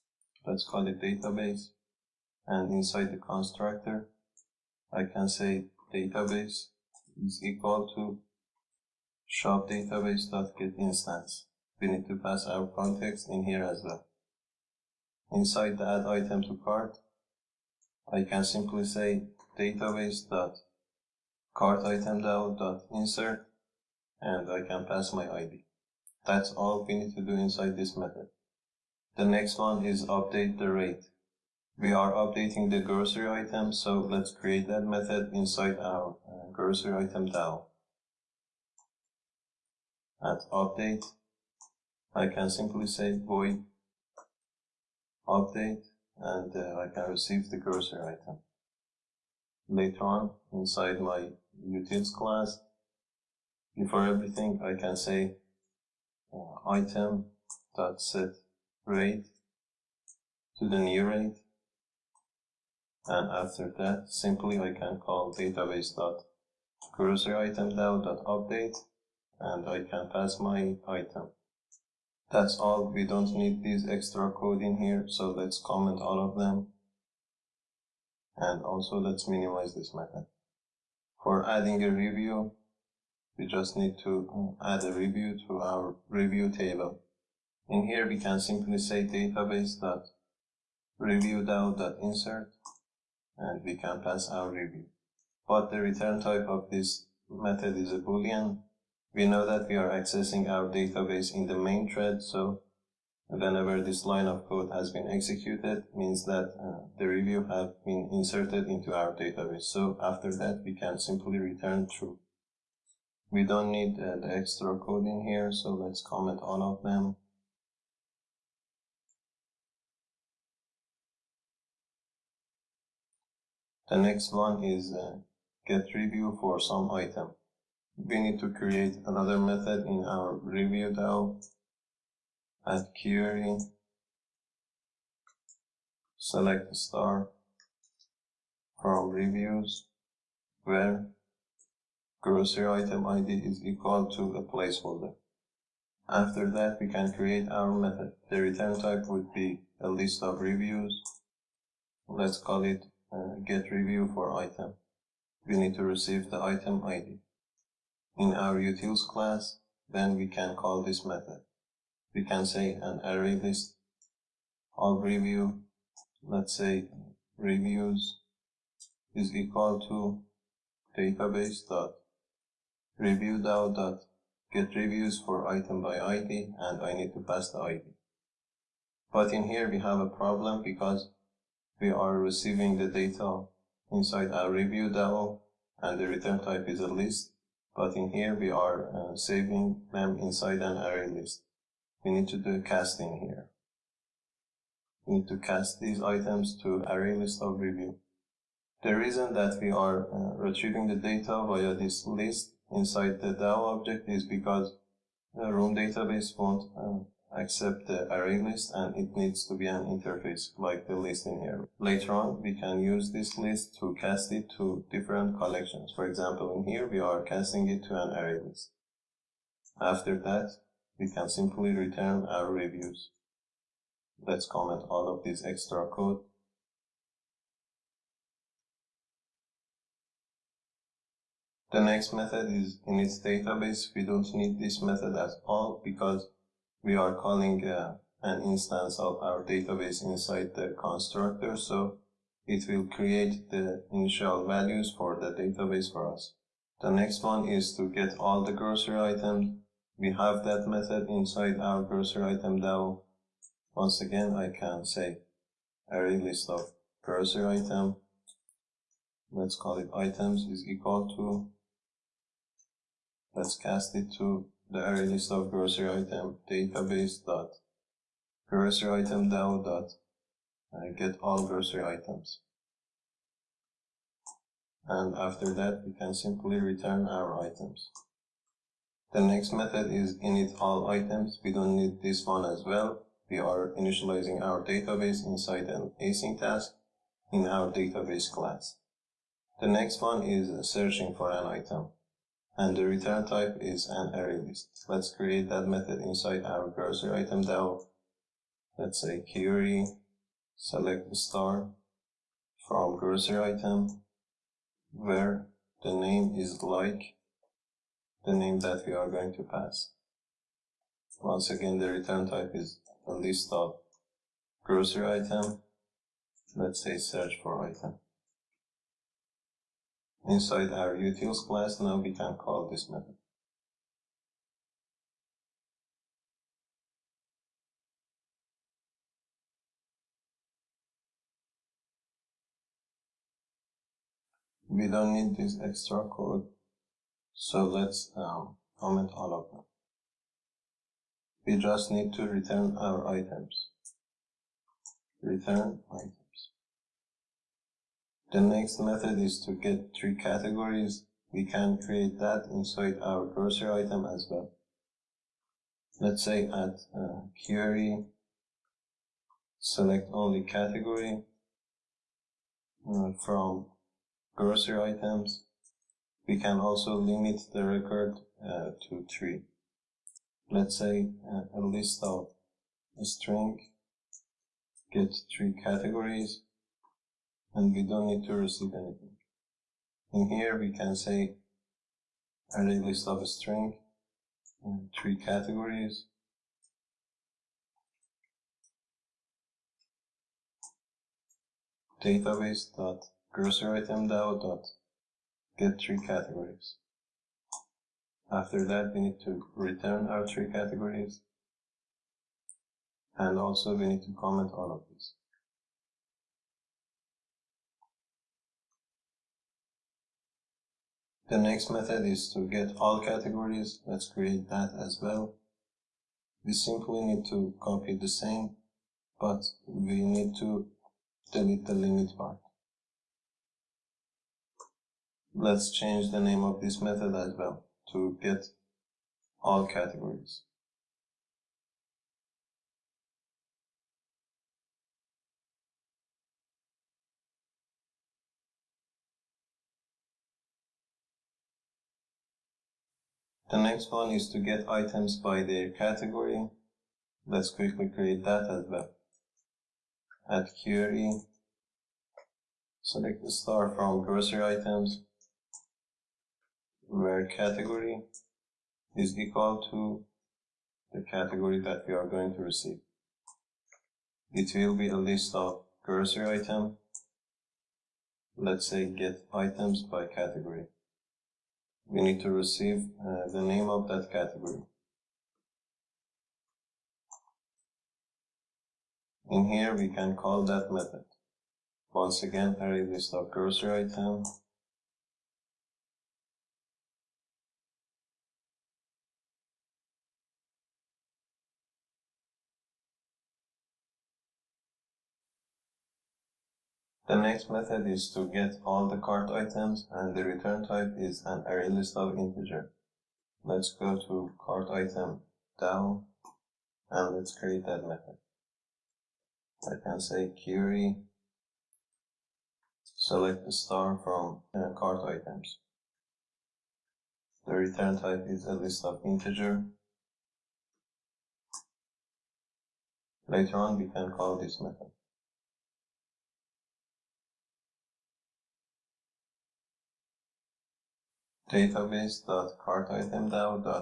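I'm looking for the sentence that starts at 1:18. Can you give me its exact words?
And also let's minimize this method.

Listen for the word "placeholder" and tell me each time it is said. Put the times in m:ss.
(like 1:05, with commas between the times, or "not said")
2:24.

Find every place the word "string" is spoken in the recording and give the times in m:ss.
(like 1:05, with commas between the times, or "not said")
6:13, 6:23.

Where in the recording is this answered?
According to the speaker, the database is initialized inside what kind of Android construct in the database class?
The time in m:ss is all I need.
4:45.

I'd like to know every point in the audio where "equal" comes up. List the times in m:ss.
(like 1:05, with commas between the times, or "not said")
0:07, 2:23, 2:49, 4:20, 7:39.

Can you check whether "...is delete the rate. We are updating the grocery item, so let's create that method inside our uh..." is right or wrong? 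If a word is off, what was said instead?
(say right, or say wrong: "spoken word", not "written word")
wrong: "update", not "delete".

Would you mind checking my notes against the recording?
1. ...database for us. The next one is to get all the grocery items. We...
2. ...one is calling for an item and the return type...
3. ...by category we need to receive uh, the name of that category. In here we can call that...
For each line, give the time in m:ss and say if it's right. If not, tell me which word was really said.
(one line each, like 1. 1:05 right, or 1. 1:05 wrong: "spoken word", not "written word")
1. 4:05 right
2. 4:50 wrong: "searching", not "calling"
3. 7:49 right.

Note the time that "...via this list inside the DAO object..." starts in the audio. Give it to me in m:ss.
3:21.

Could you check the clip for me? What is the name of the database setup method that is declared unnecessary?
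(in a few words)
init database.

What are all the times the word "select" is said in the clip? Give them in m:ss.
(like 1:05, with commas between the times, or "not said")
2:16, 5:00, 5:59, 7:32, 8:32.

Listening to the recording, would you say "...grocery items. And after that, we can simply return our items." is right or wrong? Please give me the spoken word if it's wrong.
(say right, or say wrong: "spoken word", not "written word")
right.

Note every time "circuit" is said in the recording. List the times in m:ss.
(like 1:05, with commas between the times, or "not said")
not said.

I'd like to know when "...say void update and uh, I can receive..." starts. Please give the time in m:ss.
0:42.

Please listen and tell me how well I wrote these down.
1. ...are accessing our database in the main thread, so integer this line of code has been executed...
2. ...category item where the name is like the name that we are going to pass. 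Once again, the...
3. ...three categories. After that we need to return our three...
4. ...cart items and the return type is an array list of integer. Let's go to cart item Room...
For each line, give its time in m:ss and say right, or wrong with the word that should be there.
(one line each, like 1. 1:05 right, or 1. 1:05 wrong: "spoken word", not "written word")
1. 1:39 wrong: "whenever", not "integer"
2. 5:02 wrong: "grocery", not "category"
3. 6:35 right
4. 8:18 wrong: "DAO", not "Room".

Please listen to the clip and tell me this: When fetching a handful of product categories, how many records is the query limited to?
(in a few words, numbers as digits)
3.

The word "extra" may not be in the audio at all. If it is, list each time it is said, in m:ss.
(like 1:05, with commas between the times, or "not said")
1:13, 1:54, 3:45, 5:35.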